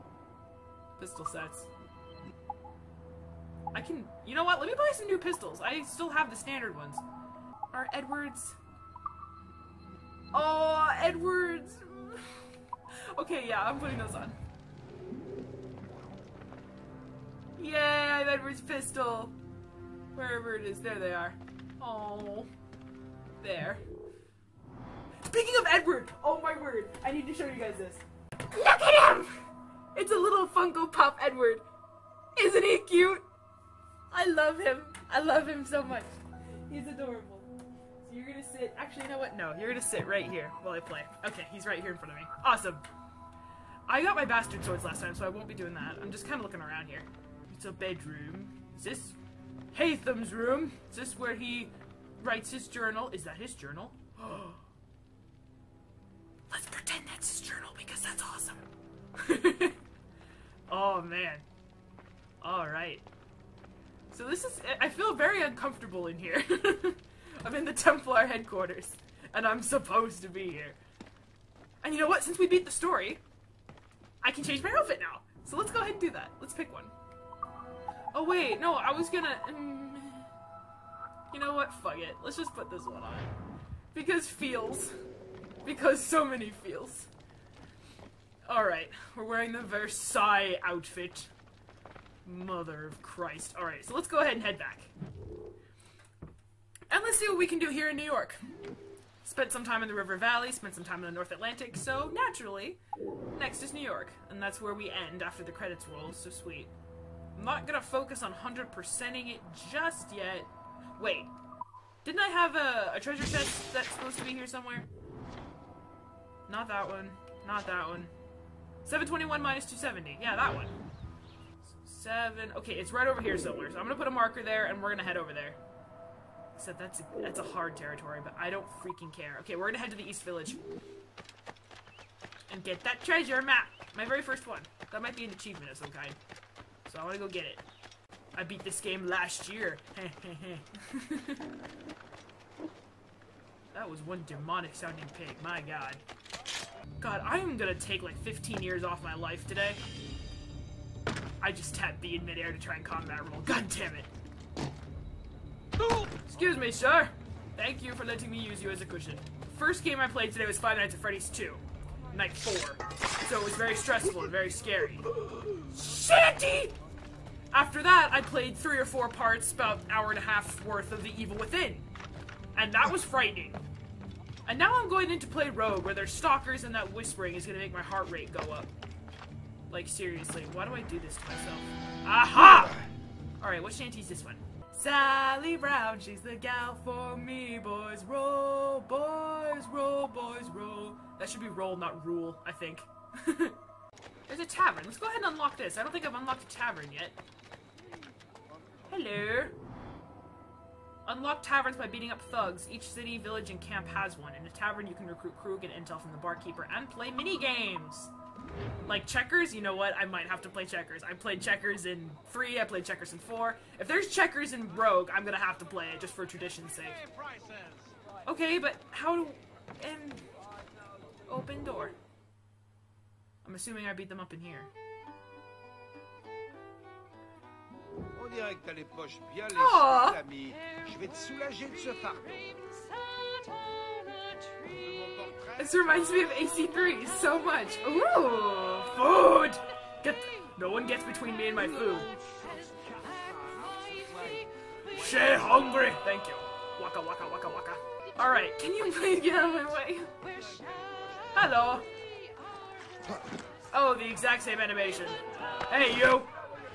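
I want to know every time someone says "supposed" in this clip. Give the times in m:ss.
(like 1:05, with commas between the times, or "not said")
1:09, 1:53.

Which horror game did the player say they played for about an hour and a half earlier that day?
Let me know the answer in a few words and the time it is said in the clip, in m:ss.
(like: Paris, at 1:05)
The Evil Within, at 2:51.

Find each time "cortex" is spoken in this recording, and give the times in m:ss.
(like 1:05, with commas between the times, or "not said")
not said.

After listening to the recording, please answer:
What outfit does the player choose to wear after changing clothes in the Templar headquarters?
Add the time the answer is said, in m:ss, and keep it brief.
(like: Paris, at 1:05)
Versailles outfit, at 1:29.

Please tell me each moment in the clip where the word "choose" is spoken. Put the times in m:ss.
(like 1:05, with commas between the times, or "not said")
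not said.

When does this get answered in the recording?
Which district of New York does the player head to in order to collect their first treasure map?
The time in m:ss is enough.
2:10.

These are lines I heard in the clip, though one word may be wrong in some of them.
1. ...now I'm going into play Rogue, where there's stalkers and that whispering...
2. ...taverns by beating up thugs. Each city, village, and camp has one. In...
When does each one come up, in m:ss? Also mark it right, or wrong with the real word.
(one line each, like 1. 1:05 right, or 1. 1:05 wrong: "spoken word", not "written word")
1. 2:54 right
2. 3:21 right.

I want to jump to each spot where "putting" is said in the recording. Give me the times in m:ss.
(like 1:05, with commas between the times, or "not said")
0:13.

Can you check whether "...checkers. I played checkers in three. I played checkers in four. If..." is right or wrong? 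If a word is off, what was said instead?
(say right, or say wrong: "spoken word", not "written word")
right.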